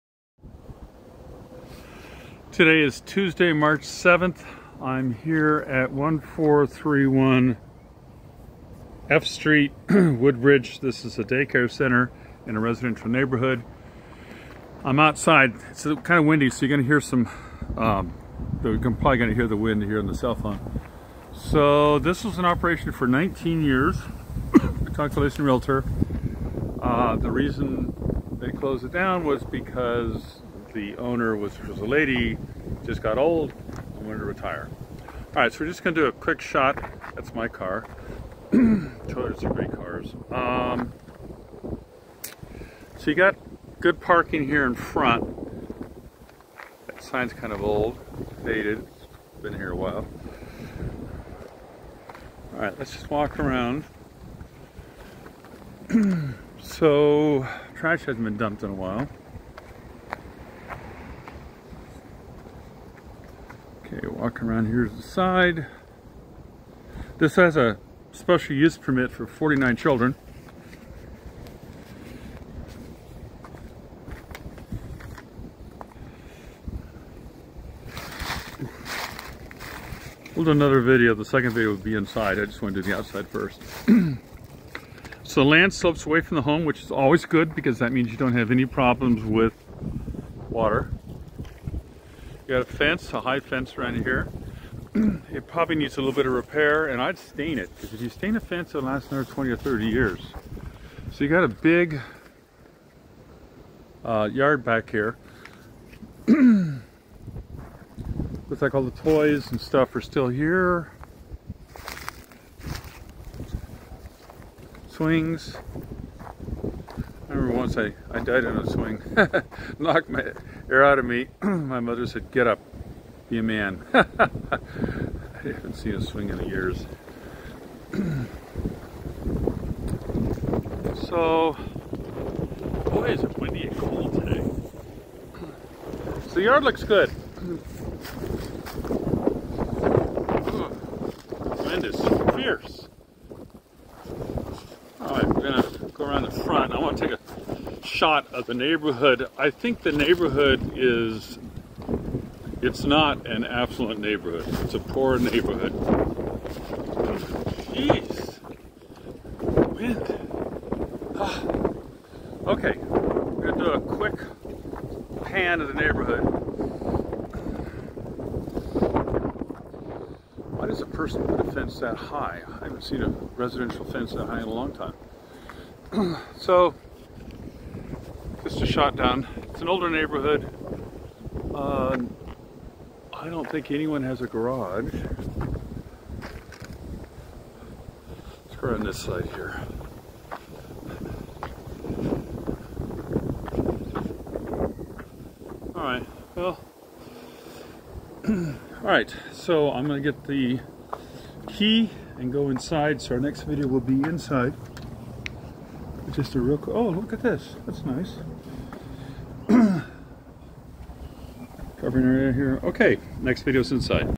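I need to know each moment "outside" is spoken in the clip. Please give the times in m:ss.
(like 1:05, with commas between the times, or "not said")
0:14, 1:22.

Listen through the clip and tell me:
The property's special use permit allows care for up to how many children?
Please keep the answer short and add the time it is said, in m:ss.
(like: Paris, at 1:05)
49, at 1:09.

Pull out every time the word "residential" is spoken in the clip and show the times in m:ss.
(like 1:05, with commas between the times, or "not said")
0:12, 2:53.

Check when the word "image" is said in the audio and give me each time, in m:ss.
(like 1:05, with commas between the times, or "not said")
not said.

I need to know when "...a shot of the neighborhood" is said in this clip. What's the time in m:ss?
2:27.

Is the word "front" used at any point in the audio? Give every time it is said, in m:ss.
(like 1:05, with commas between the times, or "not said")
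0:44, 2:26.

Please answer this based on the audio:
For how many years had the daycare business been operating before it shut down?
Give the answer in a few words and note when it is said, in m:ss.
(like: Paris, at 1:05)
19, at 0:23.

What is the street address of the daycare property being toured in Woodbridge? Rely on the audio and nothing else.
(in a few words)
1431 F Street.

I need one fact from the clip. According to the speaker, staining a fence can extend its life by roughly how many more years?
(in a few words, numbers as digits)
20 or 30.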